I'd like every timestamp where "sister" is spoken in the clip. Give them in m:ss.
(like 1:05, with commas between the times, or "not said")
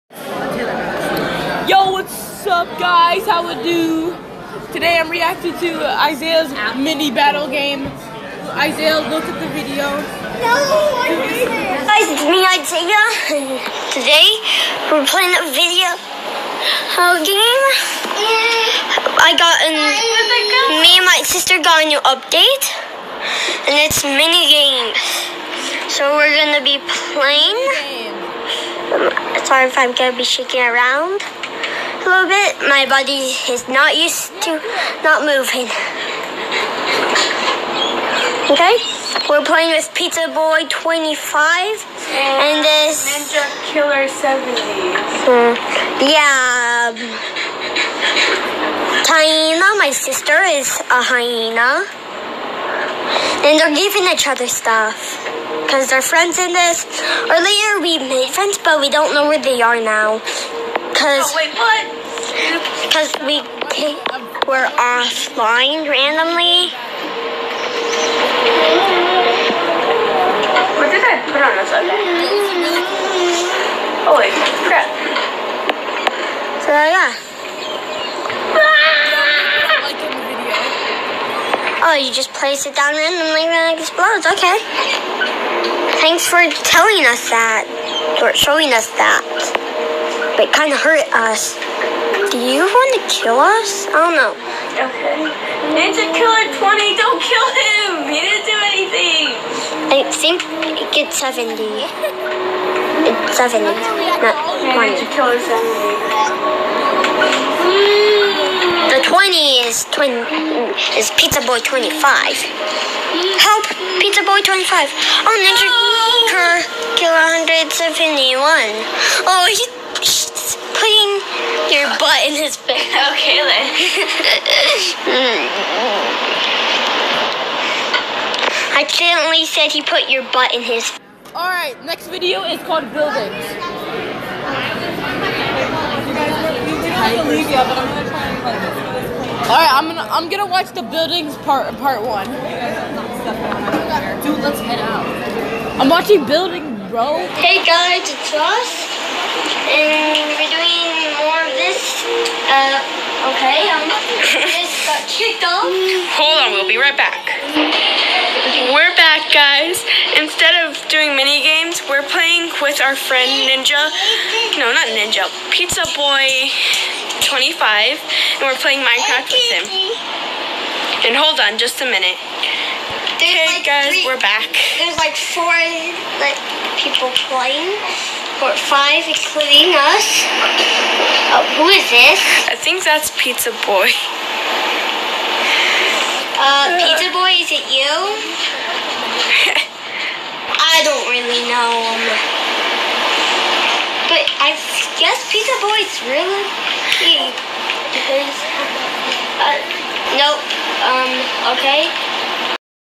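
0:21, 0:49.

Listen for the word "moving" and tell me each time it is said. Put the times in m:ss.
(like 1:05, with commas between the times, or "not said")
0:35.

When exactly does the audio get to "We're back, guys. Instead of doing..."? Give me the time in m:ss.
2:38.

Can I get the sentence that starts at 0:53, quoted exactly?
And they're giving each other stuff.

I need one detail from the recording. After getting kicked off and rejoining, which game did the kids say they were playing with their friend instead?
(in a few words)
Minecraft.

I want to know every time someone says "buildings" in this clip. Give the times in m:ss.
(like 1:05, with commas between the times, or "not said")
2:12, 2:20, 2:26.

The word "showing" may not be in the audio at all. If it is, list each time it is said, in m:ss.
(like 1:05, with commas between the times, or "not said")
1:28.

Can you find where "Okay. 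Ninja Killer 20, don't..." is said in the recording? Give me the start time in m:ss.
1:34.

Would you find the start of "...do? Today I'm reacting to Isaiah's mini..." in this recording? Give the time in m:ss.
0:03.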